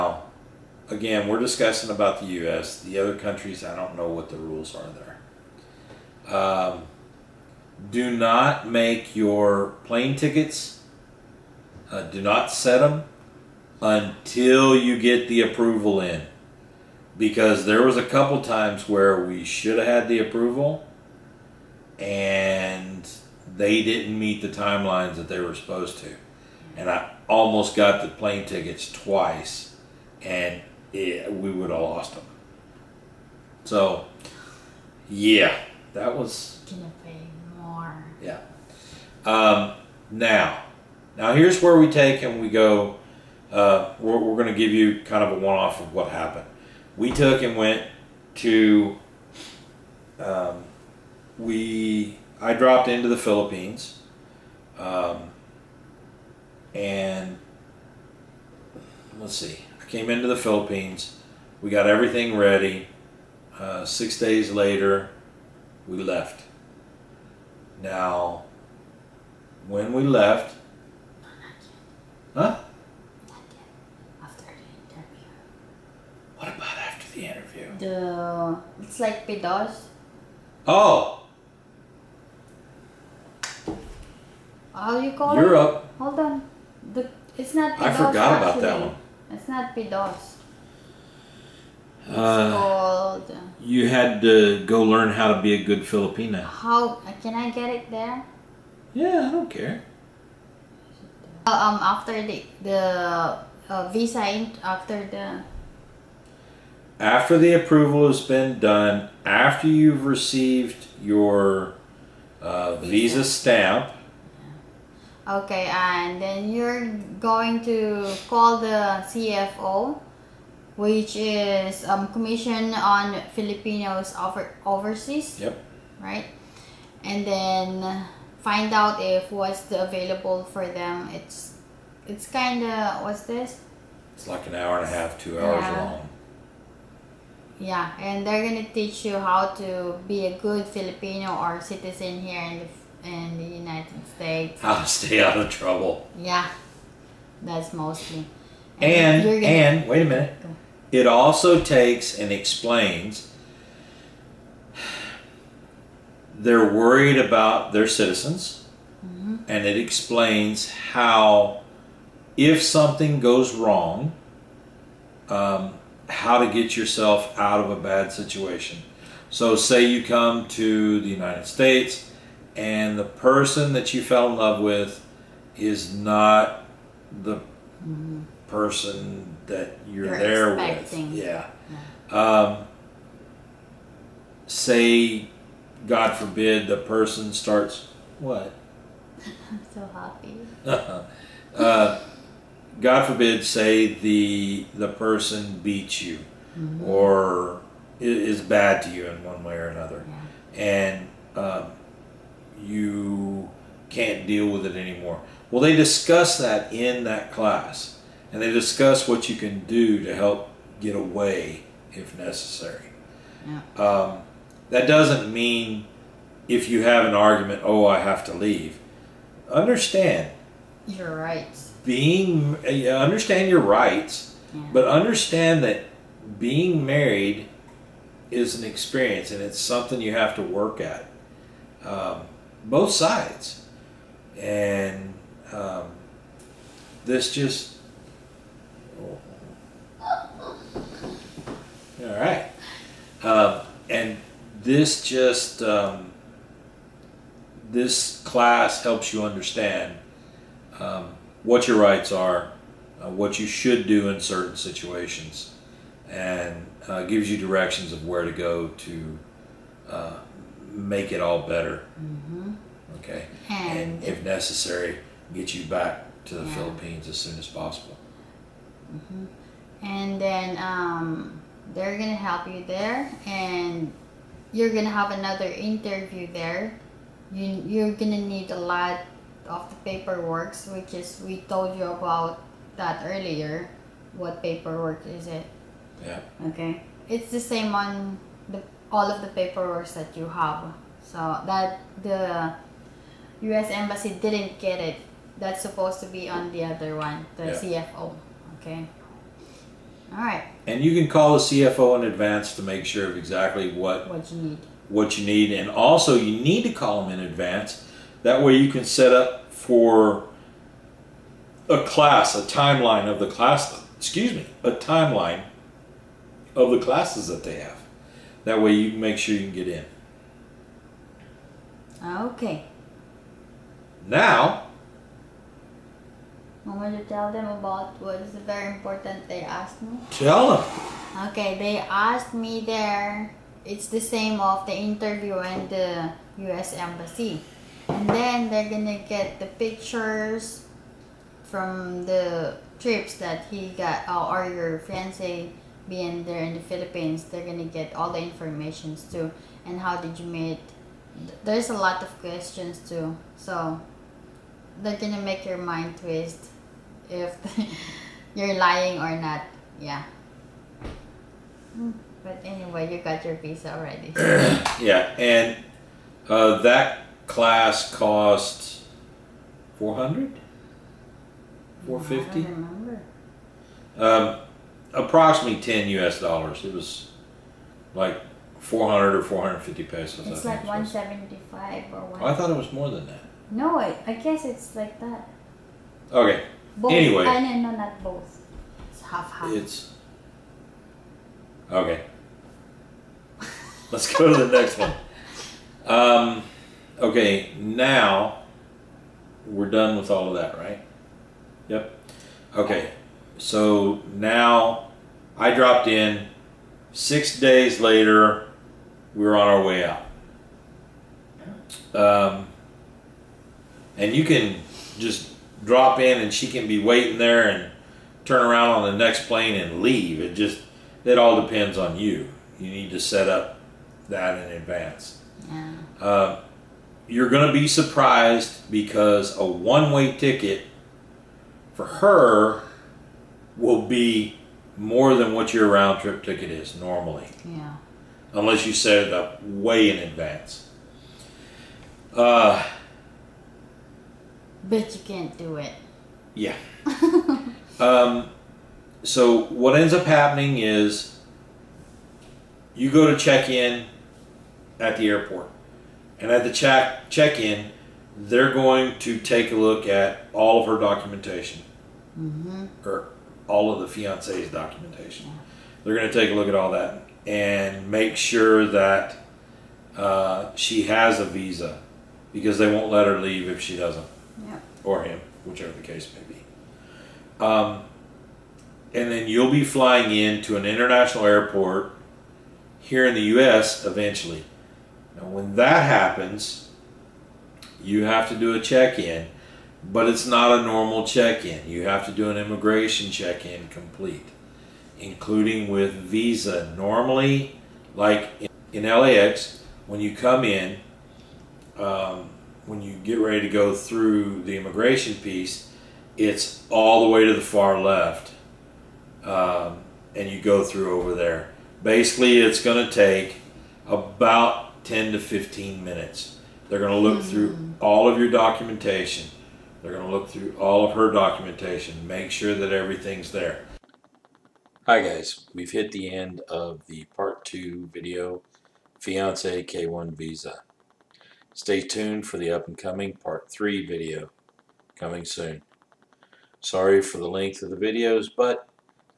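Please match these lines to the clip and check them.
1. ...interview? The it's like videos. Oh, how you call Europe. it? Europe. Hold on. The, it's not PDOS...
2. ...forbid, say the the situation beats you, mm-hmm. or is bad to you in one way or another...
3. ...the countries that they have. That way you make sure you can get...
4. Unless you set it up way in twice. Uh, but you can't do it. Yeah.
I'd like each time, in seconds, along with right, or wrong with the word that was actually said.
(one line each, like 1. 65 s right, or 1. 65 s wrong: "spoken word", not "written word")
1. 77 s wrong: "pedos", not "videos"
2. 193 s wrong: "person", not "situation"
3. 316 s wrong: "classes", not "countries"
4. 438 s wrong: "advance", not "twice".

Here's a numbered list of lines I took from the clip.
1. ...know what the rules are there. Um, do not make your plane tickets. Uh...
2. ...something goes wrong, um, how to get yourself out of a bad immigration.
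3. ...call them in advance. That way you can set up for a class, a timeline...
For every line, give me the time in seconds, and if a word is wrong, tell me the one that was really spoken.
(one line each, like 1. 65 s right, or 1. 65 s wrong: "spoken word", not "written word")
1. 3 s right
2. 162 s wrong: "situation", not "immigration"
3. 306 s right.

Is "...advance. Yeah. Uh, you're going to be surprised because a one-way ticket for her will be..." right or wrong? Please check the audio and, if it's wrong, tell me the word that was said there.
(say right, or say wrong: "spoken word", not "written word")
right.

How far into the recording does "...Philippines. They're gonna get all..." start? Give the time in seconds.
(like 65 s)
346 s.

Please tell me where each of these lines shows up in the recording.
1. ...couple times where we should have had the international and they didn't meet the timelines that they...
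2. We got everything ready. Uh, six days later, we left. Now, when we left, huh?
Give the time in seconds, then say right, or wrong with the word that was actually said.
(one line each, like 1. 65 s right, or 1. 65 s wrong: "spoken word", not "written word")
1. 18 s wrong: "approval", not "international"
2. 61 s right.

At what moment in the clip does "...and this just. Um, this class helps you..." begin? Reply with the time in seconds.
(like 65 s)
243 s.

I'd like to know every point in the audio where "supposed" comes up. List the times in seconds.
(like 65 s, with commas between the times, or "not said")
25 s, 295 s.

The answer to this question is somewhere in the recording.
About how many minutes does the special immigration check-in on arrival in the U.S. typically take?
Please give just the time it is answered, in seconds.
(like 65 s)
514 s.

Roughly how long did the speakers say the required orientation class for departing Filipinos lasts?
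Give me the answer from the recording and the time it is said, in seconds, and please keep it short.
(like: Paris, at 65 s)
hour and a half to 2 hours, at 134 s.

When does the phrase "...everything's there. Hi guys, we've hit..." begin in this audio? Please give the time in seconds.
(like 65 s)
522 s.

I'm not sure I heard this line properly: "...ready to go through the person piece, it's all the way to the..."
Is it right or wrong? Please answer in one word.
wrong.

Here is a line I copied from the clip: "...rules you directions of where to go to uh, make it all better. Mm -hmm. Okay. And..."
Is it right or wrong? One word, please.
wrong.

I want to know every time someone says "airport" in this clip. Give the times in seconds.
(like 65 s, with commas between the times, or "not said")
455 s, 481 s.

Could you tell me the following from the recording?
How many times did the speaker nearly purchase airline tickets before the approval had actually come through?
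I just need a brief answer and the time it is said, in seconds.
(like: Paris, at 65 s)
twice, at 28 s.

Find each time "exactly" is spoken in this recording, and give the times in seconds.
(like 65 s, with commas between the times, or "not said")
303 s.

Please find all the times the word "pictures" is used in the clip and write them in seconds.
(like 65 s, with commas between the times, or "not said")
339 s.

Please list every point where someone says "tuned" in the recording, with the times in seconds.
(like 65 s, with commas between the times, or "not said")
531 s.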